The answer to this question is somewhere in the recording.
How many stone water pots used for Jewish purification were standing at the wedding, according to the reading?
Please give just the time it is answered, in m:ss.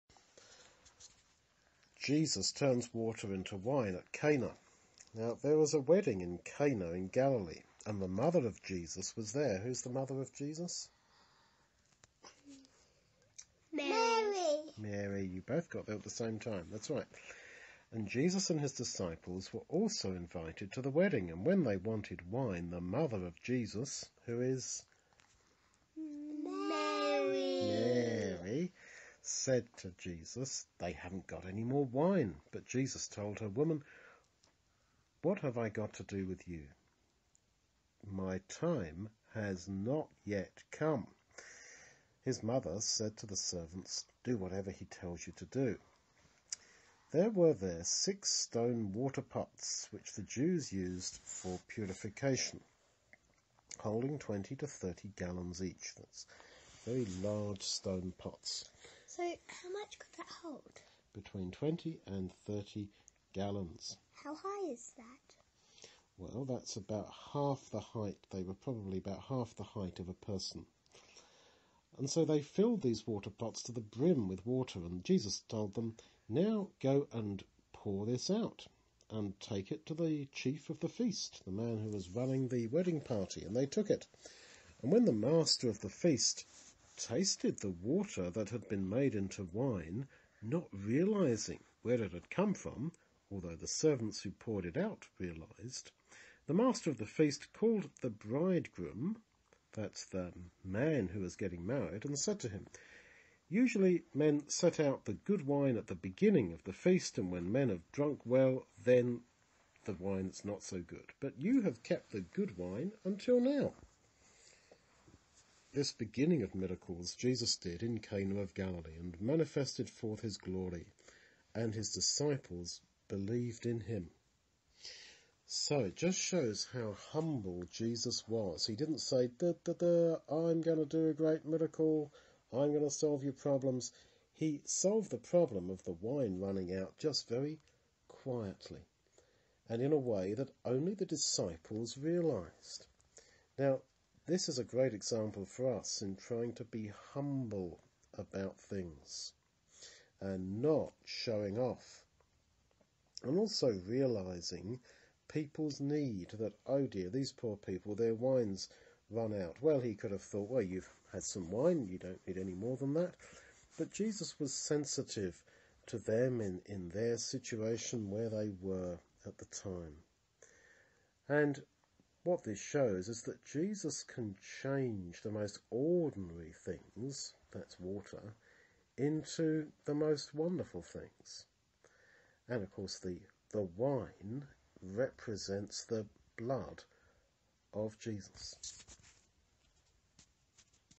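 0:47.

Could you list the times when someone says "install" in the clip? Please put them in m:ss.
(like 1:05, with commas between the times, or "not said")
not said.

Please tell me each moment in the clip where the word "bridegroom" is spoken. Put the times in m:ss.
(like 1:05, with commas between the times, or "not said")
1:38.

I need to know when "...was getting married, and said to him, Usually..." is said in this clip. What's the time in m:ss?
1:41.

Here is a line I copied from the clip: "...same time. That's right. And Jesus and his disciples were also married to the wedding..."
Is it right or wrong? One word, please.
wrong.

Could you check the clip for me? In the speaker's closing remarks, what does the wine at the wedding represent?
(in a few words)
the blood of Jesus.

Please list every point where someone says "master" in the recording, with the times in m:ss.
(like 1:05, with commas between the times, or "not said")
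1:25, 1:36.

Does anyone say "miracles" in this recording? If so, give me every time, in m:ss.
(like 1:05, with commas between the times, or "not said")
1:56, 2:11.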